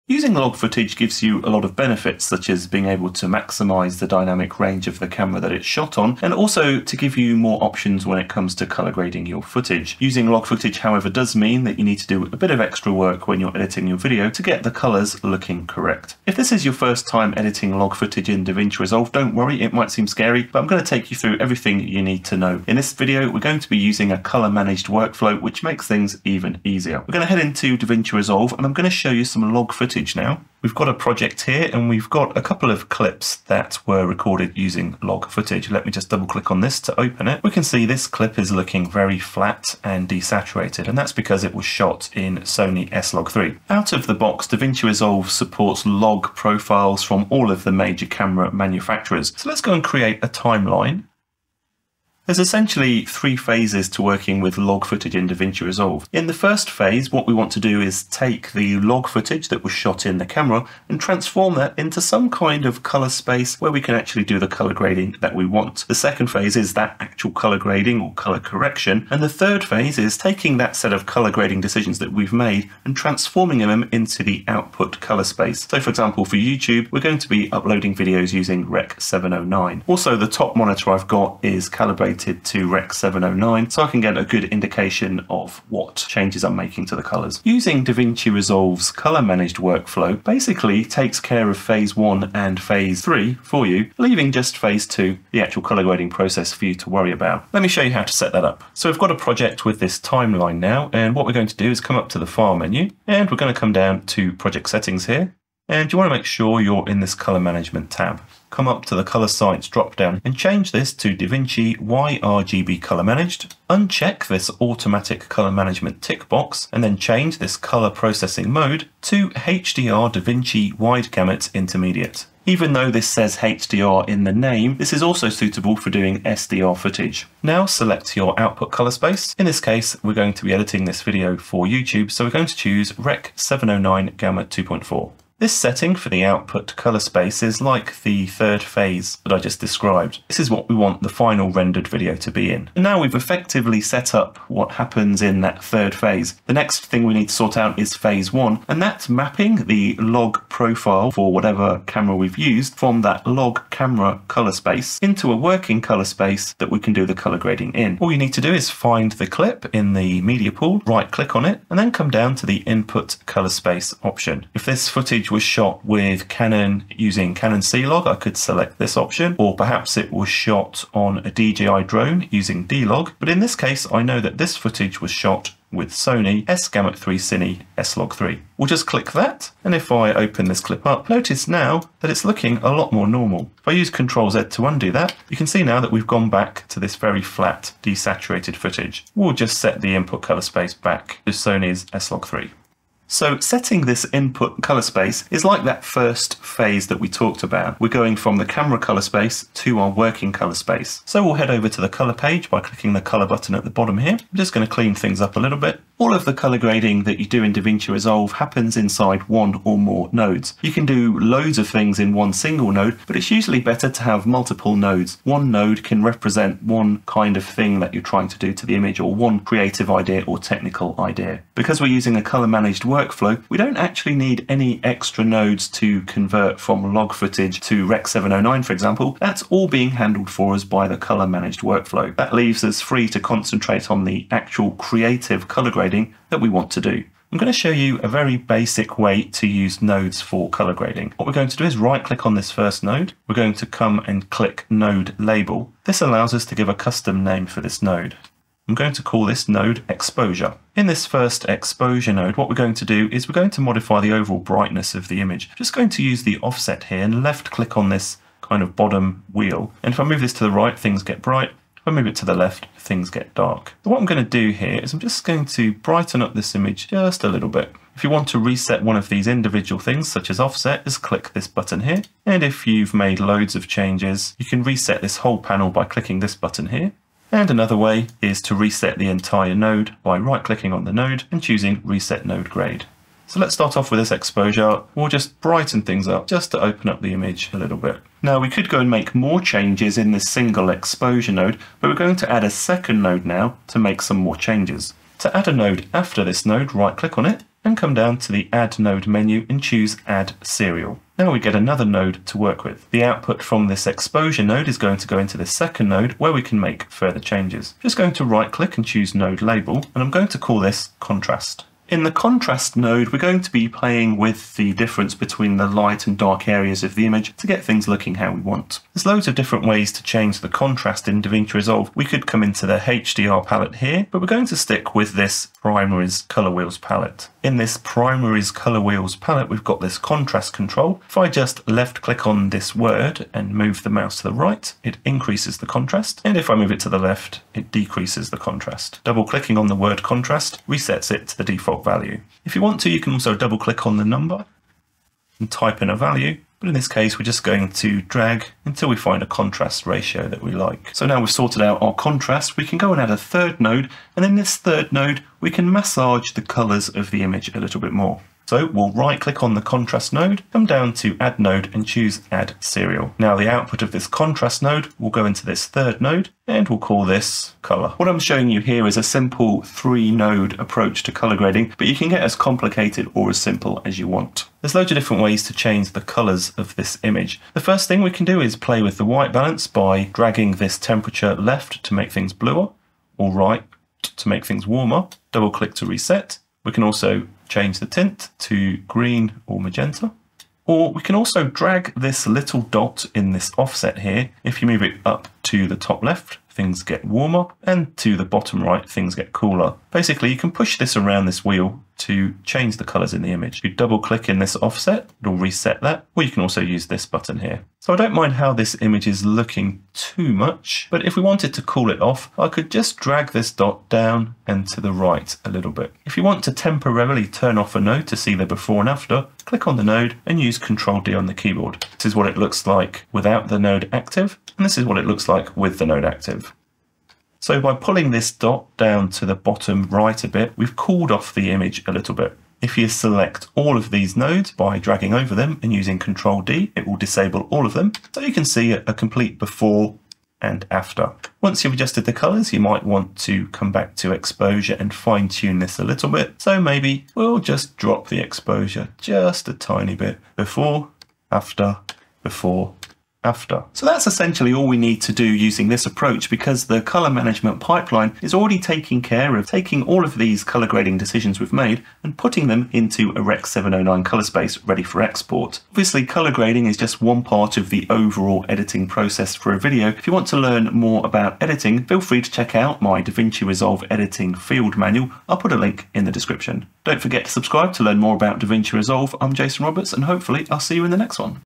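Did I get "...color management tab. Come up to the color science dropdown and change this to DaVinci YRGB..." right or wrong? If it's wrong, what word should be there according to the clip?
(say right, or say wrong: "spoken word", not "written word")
right.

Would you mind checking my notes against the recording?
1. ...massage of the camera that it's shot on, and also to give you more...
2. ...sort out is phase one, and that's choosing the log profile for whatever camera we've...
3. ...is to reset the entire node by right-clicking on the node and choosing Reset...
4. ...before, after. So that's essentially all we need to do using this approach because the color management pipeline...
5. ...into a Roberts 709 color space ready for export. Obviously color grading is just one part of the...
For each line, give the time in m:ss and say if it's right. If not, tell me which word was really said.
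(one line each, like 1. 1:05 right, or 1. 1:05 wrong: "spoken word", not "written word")
1. 0:04 wrong: "range", not "massage"
2. 2:27 wrong: "mapping", not "choosing"
3. 4:38 right
4. 7:32 right
5. 7:42 wrong: "Rec", not "Roberts".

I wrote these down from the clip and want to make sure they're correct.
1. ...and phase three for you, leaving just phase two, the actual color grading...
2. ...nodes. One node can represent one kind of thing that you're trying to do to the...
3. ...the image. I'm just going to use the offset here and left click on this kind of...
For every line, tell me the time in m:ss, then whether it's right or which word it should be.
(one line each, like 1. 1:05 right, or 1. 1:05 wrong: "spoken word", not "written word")
1. 1:32 right
2. 3:34 right
3. 4:15 right.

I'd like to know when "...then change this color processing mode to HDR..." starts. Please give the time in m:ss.
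1:56.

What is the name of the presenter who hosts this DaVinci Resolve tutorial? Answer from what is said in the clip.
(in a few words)
Jason Roberts.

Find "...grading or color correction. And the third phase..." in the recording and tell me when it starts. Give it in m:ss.
1:07.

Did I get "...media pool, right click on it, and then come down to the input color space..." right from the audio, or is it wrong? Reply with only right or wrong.
right.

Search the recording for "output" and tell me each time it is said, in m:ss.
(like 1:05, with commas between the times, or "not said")
1:14, 2:08, 2:16, 5:03, 6:03.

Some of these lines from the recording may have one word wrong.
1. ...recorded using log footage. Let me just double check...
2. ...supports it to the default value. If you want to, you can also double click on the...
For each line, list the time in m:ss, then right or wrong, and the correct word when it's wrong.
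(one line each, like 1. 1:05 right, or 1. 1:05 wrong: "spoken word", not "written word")
1. 0:34 wrong: "click", not "check"
2. 5:40 wrong: "resets", not "supports".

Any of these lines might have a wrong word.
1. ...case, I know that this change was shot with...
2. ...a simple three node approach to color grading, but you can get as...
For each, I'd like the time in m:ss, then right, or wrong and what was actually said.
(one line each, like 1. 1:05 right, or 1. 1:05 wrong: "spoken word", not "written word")
1. 2:53 wrong: "footage", not "change"
2. 6:08 right.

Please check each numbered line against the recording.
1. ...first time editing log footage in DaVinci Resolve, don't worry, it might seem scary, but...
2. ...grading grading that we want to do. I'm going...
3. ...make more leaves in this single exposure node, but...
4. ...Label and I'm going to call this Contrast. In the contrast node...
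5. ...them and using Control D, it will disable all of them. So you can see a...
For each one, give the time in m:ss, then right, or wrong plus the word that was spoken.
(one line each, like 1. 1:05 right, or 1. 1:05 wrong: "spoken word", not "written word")
1. 0:16 right
2. 3:55 right
3. 4:48 wrong: "changes", not "leaves"
4. 5:09 right
5. 7:15 right.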